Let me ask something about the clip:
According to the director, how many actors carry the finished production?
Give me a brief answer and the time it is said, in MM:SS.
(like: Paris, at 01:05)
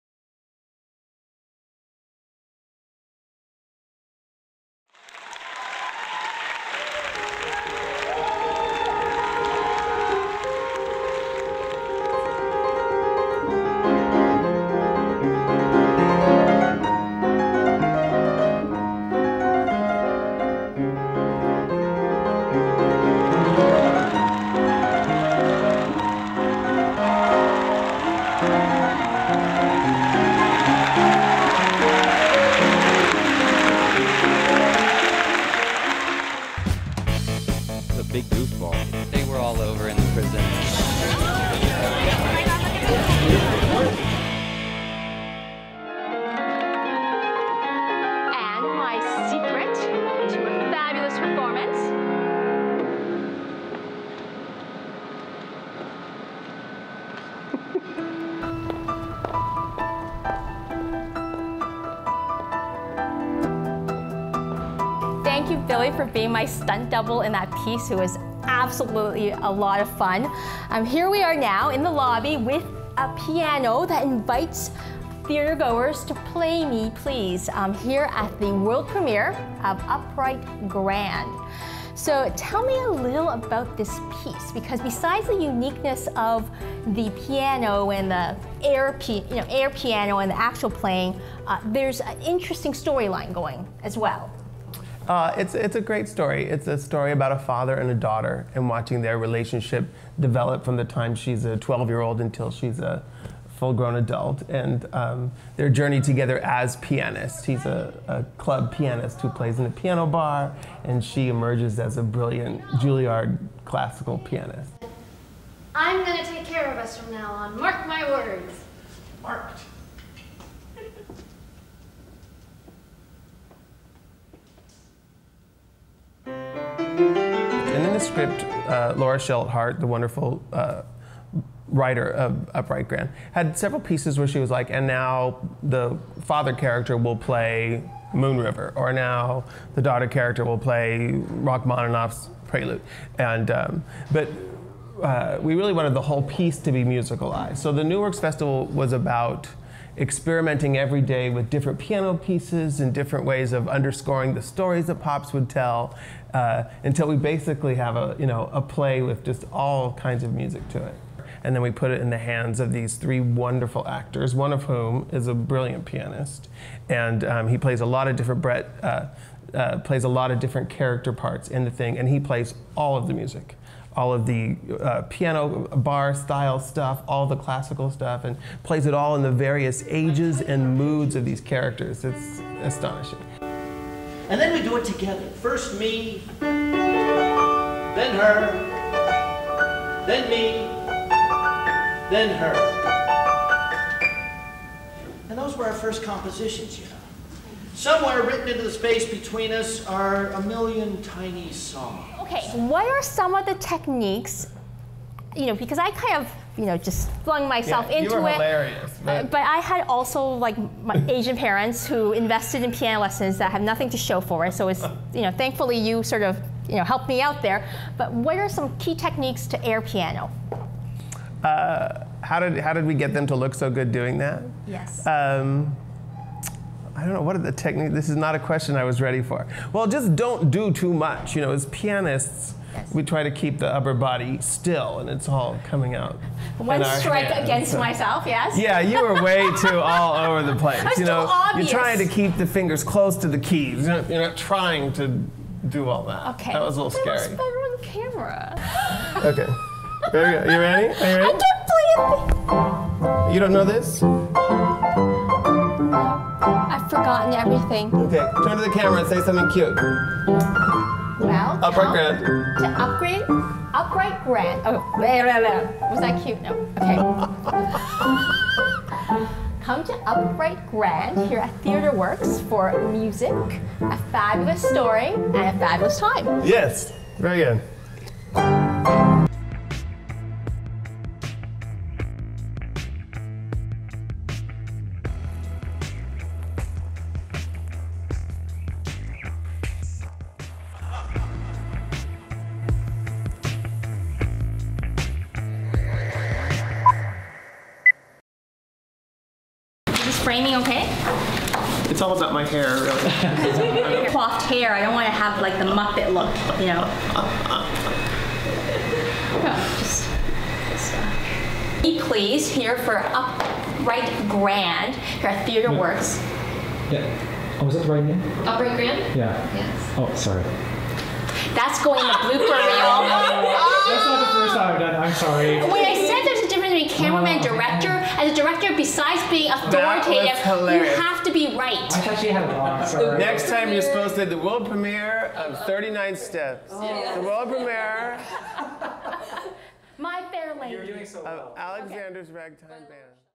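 3, at 02:42.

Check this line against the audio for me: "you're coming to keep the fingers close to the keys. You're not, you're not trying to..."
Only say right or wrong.
wrong.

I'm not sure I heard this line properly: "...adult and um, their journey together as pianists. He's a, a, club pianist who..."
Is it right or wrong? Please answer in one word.
right.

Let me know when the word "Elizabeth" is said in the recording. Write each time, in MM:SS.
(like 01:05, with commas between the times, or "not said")
not said.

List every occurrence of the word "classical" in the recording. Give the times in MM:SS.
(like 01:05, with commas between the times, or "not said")
01:53, 02:57.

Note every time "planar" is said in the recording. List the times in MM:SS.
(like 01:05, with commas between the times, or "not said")
not said.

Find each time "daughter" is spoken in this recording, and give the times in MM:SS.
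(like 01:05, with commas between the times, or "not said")
01:37, 02:19.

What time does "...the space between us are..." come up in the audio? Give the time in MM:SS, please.
03:18.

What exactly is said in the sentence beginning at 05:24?
I'm sorry cameraman oh, director, as a director, besides being authoritative, you have to be right.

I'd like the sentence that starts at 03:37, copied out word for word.
But what are some key techniques to air piano?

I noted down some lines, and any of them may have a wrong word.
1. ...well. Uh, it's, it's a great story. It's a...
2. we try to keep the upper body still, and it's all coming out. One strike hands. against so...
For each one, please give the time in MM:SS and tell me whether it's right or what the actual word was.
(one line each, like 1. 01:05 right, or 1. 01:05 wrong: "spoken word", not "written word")
1. 01:33 right
2. 03:52 right.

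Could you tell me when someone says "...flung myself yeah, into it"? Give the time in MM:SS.
03:27.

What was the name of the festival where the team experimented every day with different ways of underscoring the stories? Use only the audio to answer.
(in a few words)
New Works Festival.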